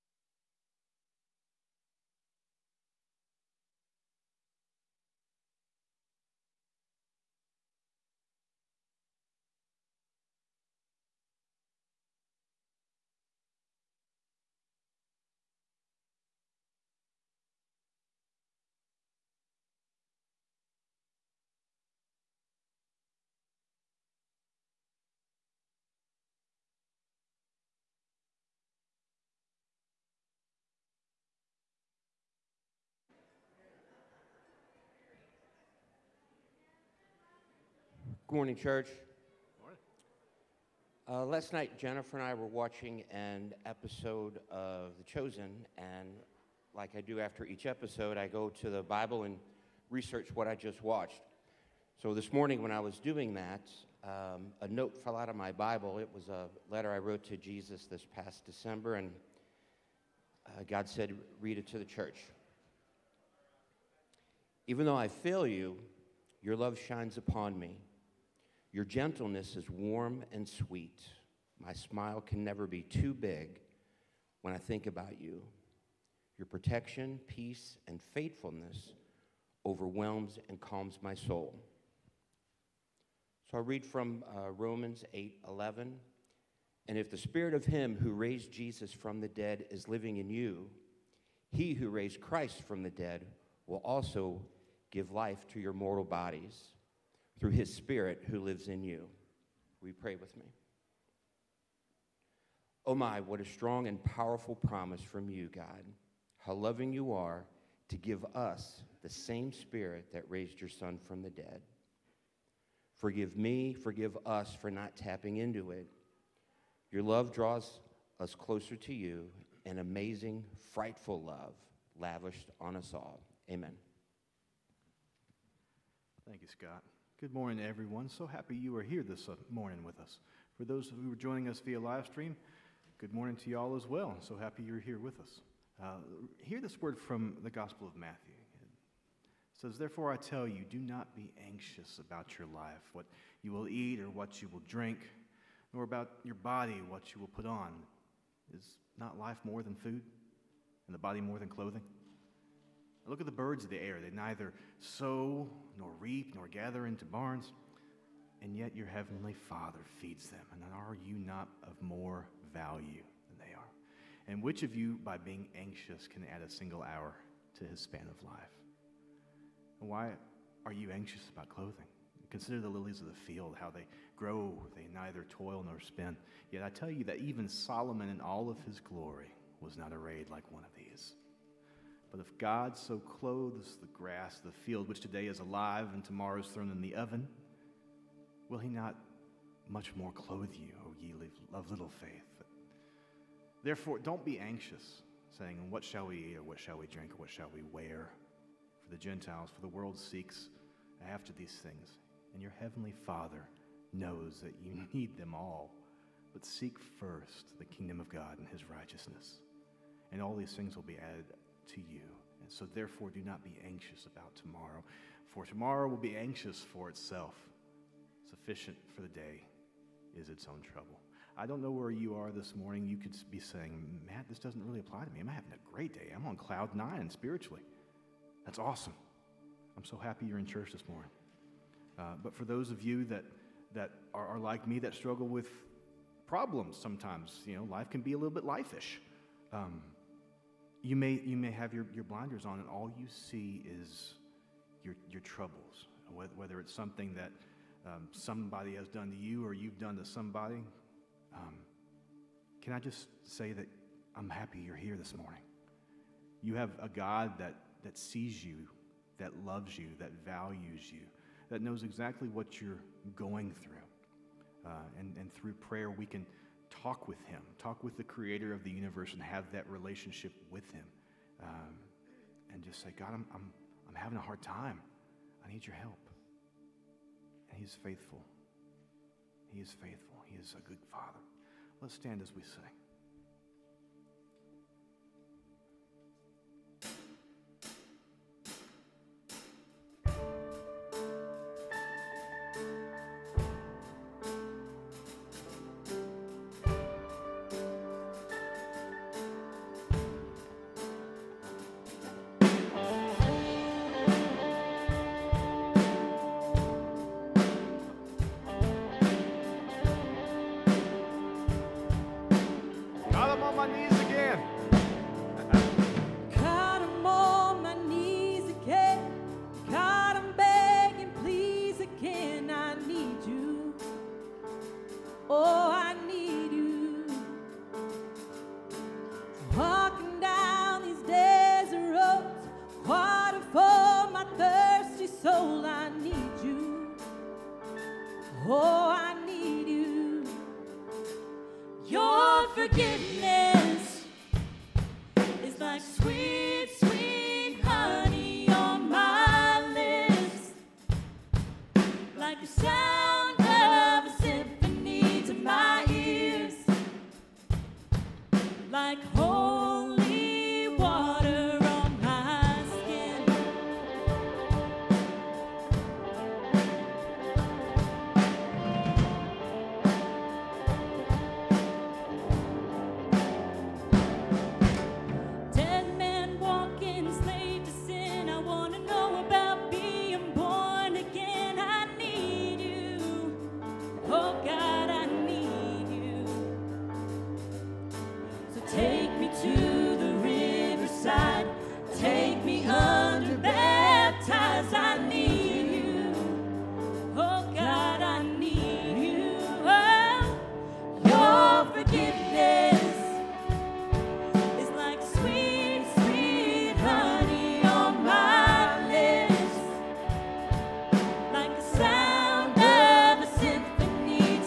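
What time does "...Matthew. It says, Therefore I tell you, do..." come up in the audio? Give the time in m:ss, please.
2:17.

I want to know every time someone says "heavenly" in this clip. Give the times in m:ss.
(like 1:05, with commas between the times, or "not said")
2:38, 3:22.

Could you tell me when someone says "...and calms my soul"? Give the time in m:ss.
1:20.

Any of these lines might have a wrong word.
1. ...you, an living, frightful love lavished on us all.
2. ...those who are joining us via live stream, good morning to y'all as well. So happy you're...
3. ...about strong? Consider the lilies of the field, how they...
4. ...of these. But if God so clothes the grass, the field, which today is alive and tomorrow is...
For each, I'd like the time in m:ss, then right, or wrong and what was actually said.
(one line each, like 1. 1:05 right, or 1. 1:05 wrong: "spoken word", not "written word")
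1. 1:58 wrong: "amazing", not "living"
2. 2:10 right
3. 2:51 wrong: "clothing", not "strong"
4. 3:00 right.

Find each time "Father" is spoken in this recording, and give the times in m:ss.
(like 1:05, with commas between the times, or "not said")
2:39, 3:23, 4:40.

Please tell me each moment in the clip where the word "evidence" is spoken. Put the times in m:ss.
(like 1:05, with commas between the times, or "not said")
not said.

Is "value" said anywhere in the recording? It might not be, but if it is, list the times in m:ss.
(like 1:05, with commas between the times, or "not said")
2:42, 4:20.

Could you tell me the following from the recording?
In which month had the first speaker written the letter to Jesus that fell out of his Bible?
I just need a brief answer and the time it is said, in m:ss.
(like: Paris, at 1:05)
December, at 0:58.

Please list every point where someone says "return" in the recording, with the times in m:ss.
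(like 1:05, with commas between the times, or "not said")
not said.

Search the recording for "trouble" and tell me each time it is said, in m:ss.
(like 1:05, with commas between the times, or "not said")
3:40, 4:05.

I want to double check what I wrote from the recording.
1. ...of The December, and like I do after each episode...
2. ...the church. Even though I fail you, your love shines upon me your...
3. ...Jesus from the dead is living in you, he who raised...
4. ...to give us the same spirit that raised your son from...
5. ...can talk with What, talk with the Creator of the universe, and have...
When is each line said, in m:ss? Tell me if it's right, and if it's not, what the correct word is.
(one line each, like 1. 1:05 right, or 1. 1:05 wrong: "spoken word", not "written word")
1. 0:44 wrong: "Chosen", not "December"
2. 1:01 right
3. 1:28 right
4. 1:47 right
5. 4:26 wrong: "Him", not "What".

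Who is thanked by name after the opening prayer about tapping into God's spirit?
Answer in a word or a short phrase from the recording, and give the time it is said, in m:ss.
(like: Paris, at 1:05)
Scott, at 2:06.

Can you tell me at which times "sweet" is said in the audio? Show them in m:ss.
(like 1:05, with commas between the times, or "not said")
1:10.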